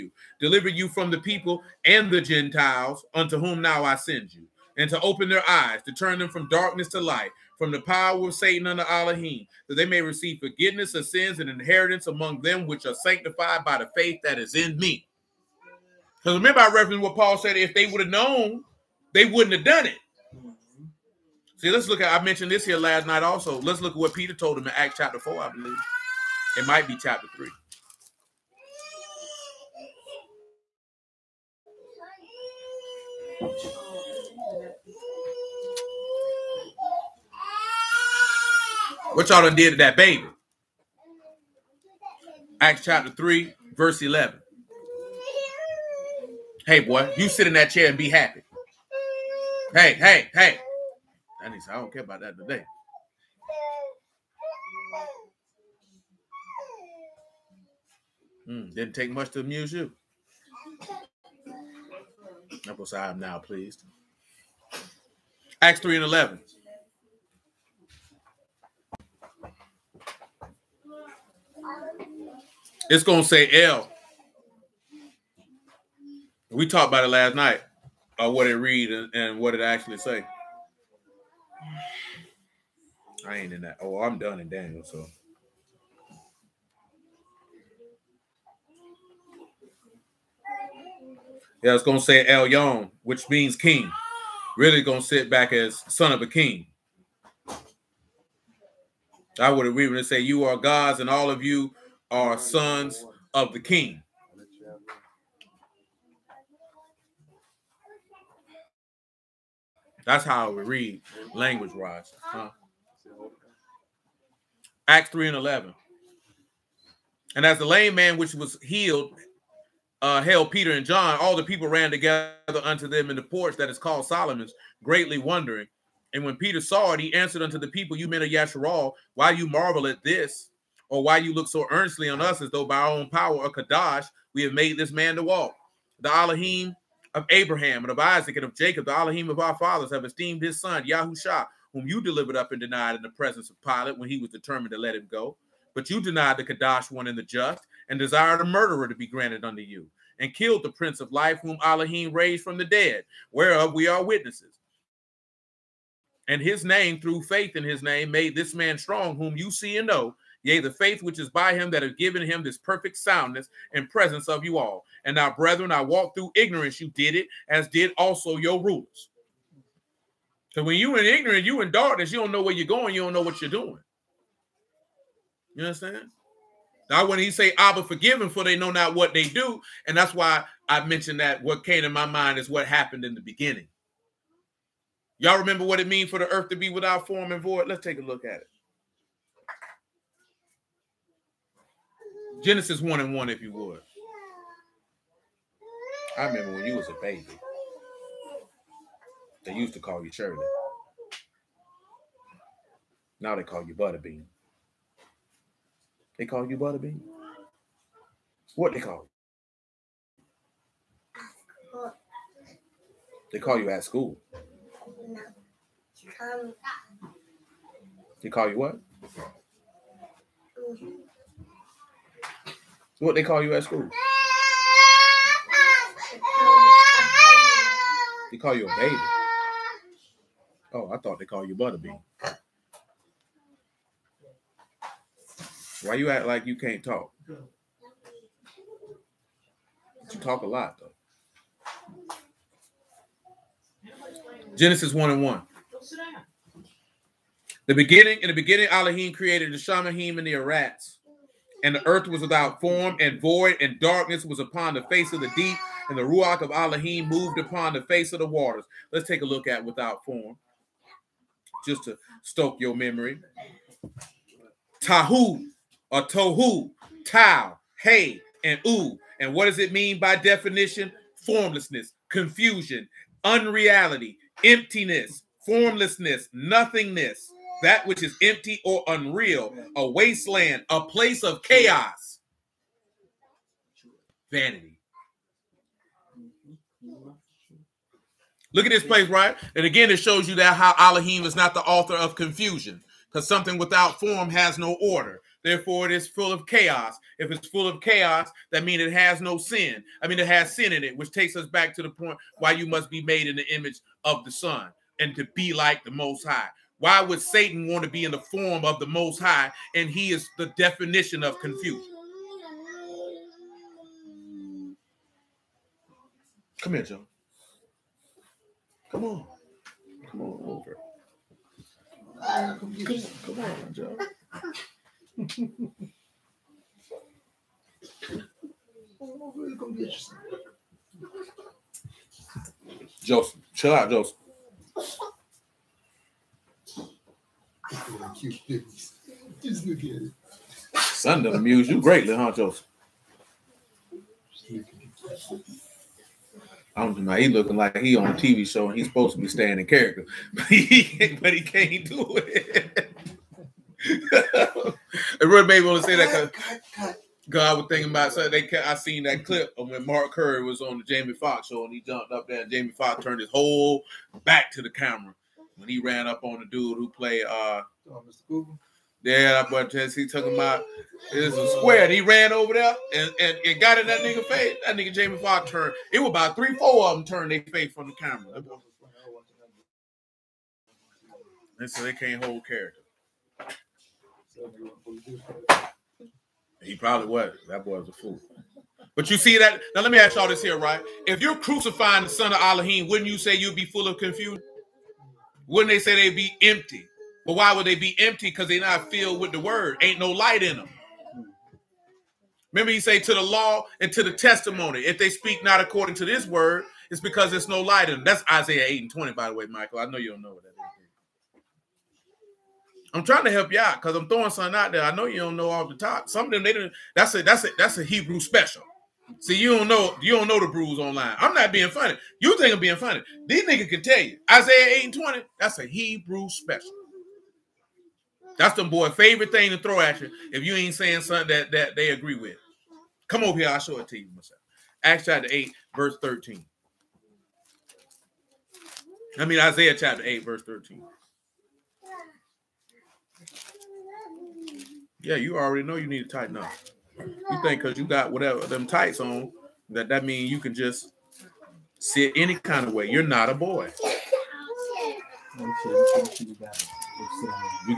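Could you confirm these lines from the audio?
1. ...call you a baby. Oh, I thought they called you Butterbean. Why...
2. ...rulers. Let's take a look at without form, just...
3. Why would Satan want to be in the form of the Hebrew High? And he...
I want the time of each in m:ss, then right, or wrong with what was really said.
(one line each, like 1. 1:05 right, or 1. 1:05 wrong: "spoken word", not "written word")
1. 3:48 right
2. 4:18 wrong: "waters", not "rulers"
3. 5:06 wrong: "Most", not "Hebrew".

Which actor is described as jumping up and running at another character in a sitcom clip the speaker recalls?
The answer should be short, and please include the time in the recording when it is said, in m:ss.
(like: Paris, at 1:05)
Mark Curry, at 5:59.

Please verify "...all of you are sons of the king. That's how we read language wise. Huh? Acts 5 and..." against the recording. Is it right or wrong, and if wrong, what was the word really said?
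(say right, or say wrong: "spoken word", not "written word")
wrong: "3", not "5".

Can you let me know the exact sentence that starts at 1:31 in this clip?
Yeah, I was gonna say El Yon, which means king.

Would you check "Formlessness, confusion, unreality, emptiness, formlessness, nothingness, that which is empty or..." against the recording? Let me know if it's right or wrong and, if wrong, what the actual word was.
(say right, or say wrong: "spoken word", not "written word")
right.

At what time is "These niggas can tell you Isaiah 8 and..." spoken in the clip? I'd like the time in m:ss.
7:03.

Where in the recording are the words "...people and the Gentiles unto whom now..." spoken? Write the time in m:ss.
0:01.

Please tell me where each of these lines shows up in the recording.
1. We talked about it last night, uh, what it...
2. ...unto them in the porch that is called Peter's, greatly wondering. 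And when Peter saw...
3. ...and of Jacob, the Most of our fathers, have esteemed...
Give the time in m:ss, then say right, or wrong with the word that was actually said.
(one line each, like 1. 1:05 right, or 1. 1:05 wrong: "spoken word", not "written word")
1. 1:16 right
2. 2:02 wrong: "Solomon", not "Peter"
3. 2:18 wrong: "Elohim", not "Most".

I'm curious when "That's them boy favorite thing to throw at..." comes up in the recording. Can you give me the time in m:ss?
7:08.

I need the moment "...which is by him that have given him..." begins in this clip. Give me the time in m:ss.
2:41.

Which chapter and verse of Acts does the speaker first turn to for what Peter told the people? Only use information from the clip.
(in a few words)
Acts 3:11.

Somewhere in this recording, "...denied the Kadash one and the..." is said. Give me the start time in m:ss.
2:26.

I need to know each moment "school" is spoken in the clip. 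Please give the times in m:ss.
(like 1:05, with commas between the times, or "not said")
3:33, 3:43.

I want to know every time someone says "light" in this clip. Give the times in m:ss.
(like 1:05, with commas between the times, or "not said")
0:07, 6:40, 6:47.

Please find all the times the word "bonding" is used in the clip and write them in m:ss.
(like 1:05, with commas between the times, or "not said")
not said.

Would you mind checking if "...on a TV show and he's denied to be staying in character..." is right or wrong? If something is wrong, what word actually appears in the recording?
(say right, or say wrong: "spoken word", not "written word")
wrong: "supposed", not "denied".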